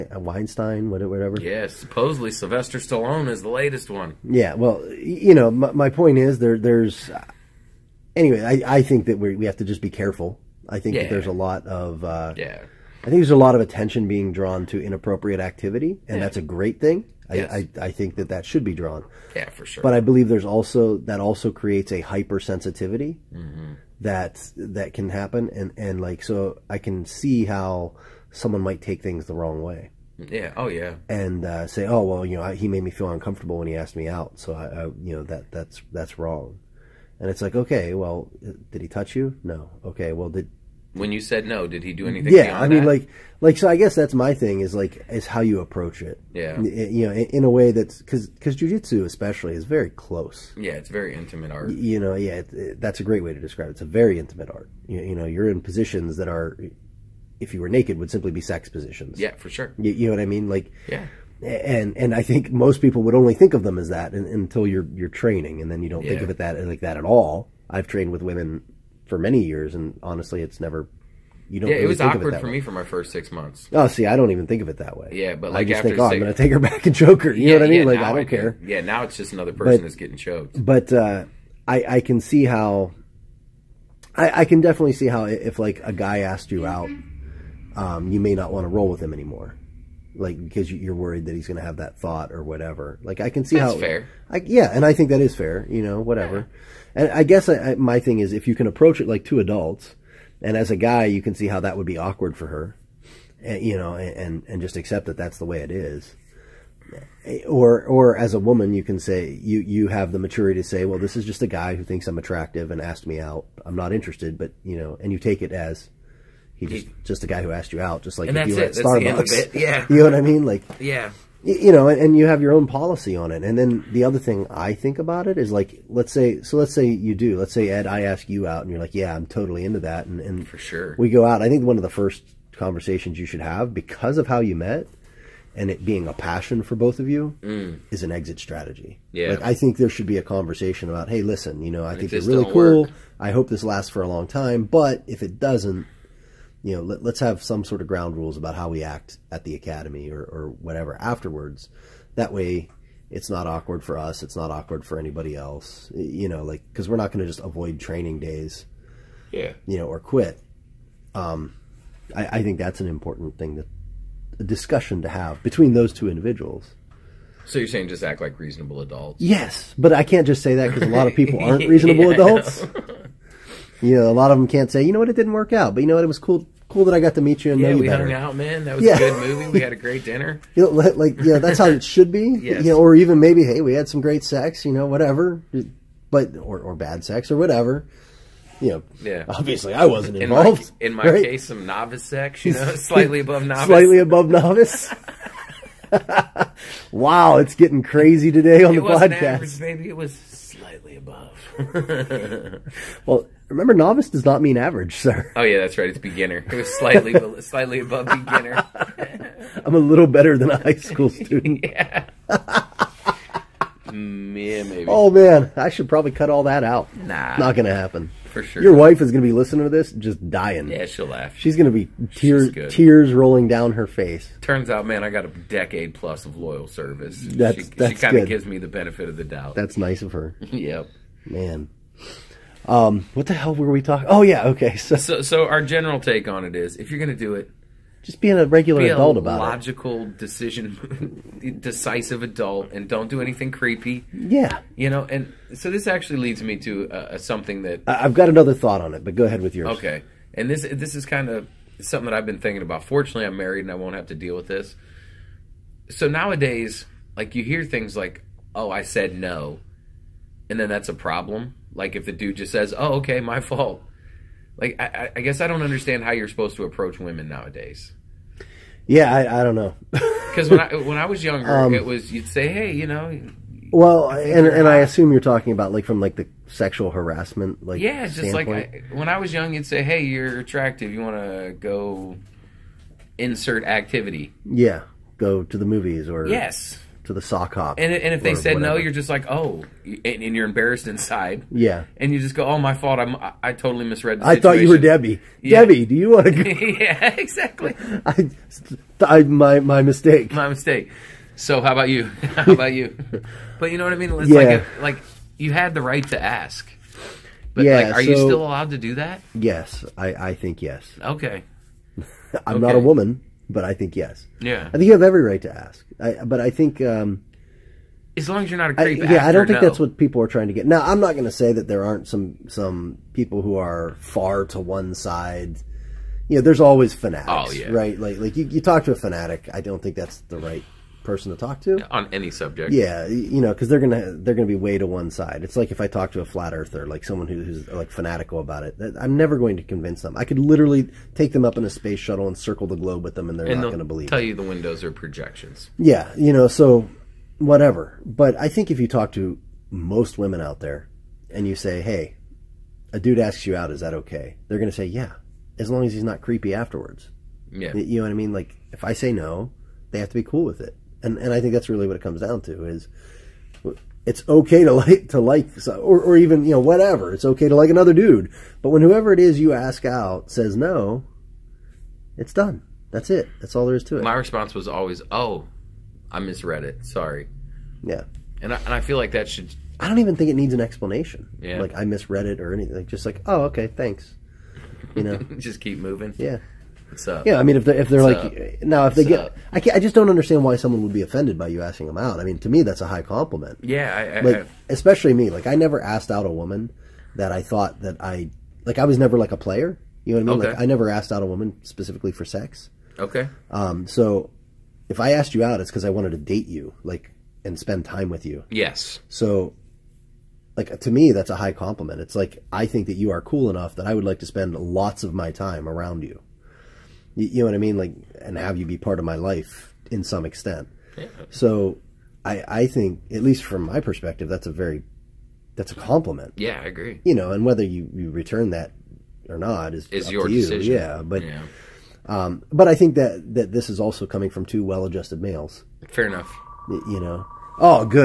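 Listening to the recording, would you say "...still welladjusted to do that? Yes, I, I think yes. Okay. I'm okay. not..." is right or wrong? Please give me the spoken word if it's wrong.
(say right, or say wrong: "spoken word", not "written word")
wrong: "allowed", not "welladjusted".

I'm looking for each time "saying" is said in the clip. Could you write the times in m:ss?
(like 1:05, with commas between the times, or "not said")
2:47.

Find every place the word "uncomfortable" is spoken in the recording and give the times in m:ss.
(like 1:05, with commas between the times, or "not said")
0:33.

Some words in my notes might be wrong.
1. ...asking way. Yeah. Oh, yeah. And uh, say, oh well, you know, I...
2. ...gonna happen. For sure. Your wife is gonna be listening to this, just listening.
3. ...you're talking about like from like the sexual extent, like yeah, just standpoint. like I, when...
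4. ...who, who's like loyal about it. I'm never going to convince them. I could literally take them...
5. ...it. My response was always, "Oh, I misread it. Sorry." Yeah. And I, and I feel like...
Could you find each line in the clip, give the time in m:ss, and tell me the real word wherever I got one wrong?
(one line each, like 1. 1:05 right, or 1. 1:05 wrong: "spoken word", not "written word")
1. 0:29 wrong: "wrong", not "asking"
2. 3:37 wrong: "dying", not "listening"
3. 4:35 wrong: "harassment", not "extent"
4. 5:37 wrong: "fanatical", not "loyal"
5. 6:13 right.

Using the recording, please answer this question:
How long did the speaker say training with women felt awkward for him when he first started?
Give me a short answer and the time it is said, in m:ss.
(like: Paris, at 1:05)
6 months, at 1:12.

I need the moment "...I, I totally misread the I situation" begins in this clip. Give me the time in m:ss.
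4:53.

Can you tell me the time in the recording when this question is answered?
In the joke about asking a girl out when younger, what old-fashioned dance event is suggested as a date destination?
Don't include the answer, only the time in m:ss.
4:47.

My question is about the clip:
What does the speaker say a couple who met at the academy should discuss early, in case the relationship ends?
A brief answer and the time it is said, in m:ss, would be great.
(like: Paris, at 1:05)
An exit strategy, at 2:18.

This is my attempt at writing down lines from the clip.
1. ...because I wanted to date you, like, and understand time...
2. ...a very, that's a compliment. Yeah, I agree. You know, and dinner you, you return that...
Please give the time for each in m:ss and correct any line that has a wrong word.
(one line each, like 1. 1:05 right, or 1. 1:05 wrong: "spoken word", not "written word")
1. 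6:45 wrong: "spend", not "understand"
2. 7:04 wrong: "whether", not "dinner".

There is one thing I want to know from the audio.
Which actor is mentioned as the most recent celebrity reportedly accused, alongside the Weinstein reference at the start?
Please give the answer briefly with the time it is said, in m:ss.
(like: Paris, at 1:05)
Sylvester Stallone, at 0:02.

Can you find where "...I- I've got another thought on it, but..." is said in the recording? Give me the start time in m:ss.
4:07.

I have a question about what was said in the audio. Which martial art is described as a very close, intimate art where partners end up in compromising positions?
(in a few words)
Jujitsu.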